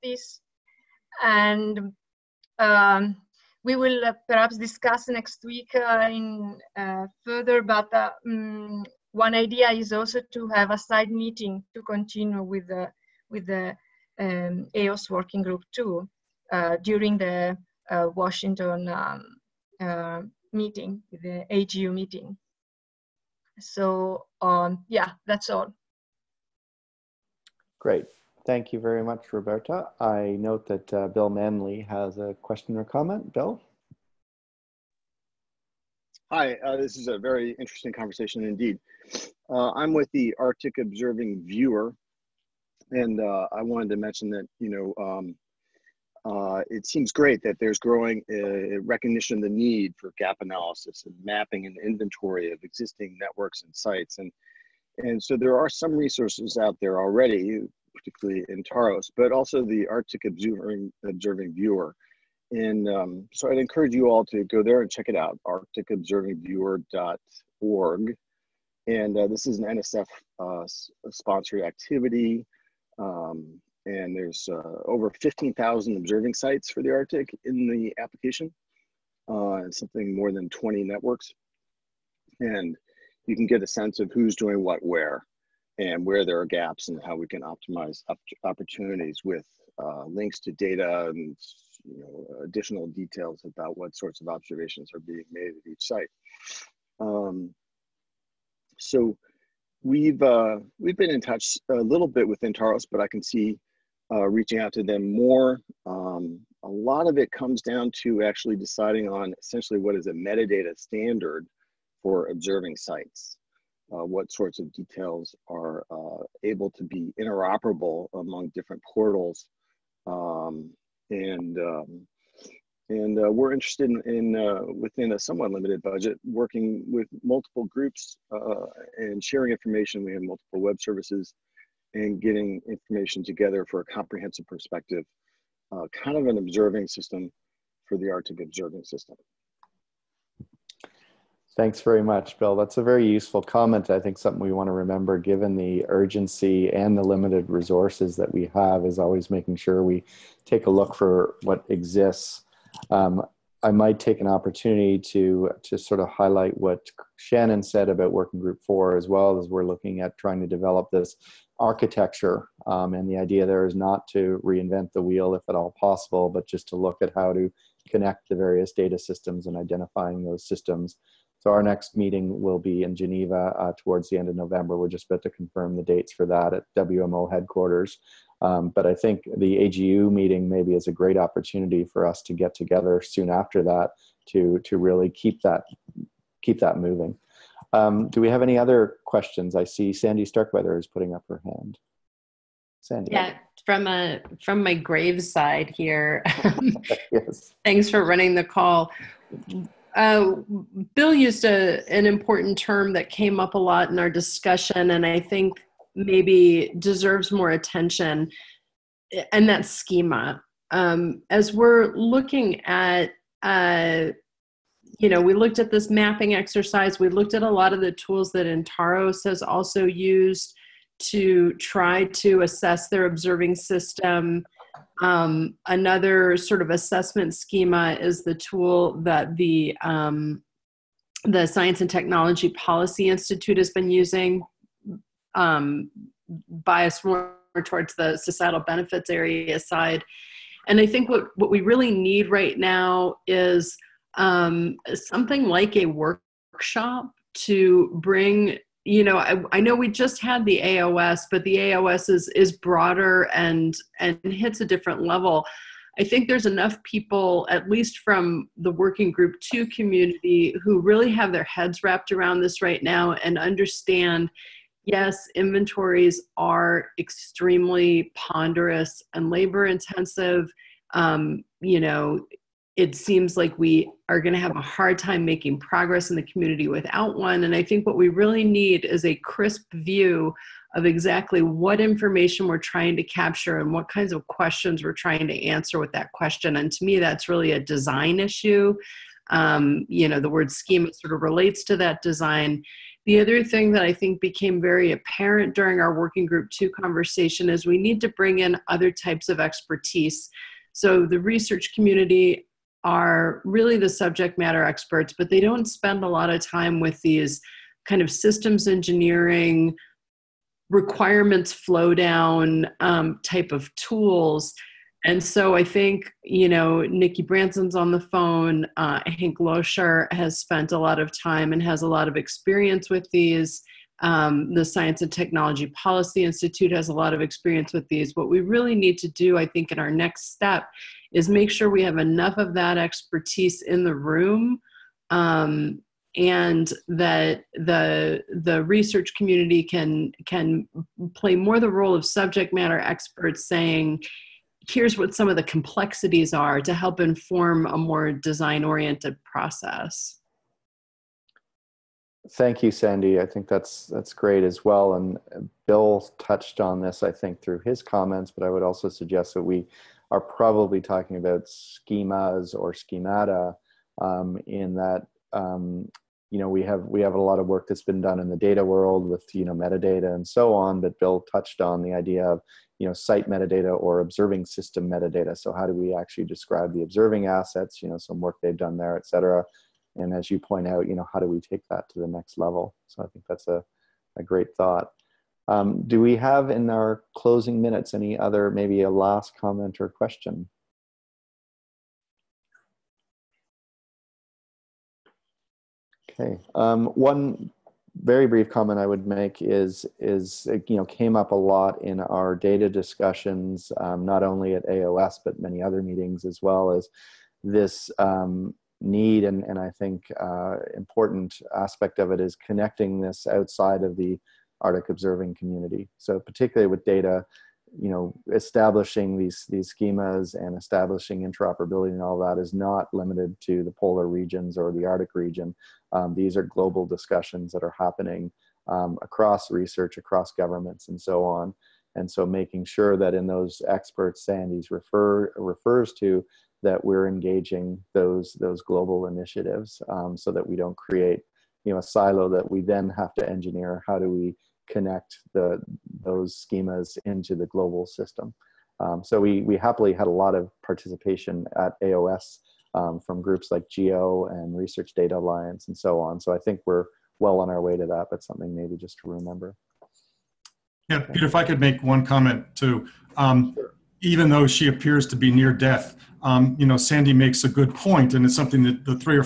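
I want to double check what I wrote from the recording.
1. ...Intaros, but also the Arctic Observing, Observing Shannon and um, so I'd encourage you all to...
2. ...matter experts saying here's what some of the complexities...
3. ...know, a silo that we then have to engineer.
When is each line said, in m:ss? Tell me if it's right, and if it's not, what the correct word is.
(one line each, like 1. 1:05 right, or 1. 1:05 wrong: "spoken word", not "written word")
1. 0:58 wrong: "Viewer", not "Shannon"
2. 5:42 right
3. 7:21 right.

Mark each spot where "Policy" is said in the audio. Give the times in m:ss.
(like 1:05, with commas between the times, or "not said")
3:52, 5:25.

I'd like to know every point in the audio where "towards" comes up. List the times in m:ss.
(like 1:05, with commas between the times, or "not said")
2:53, 3:57.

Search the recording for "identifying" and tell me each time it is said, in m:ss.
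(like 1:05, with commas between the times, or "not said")
2:49.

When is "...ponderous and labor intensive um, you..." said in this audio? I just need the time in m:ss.
4:28.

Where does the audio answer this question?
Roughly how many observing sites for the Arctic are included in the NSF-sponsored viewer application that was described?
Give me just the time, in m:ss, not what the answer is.
1:15.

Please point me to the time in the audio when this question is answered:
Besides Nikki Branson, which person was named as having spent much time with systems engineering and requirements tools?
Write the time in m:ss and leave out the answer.
5:19.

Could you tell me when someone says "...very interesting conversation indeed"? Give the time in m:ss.
0:37.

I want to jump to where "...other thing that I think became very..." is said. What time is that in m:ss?
4:53.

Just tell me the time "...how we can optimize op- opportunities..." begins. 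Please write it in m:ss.
1:27.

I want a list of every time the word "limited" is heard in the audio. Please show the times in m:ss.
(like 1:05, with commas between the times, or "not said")
2:05, 2:27, 7:02.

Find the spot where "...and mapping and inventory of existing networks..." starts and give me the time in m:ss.
0:51.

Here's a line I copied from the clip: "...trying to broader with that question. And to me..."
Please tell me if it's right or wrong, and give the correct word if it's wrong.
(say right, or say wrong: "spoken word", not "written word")
wrong: "answer", not "broader".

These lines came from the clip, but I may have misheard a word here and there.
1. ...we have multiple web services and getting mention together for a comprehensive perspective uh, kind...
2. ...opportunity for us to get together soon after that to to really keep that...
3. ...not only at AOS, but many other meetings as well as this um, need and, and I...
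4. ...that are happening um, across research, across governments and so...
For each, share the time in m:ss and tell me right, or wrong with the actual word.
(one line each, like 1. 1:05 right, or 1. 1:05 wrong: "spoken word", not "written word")
1. 2:10 wrong: "information", not "mention"
2. 3:01 right
3. 6:44 right
4. 7:07 right.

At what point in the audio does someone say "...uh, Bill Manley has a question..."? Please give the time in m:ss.
0:30.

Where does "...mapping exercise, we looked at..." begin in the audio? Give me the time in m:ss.
3:35.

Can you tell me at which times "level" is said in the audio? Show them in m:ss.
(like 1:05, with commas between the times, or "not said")
4:15, 6:22.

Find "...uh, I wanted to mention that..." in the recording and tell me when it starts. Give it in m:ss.
0:43.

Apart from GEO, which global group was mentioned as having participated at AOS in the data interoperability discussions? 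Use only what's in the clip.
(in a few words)
Research Data Alliance.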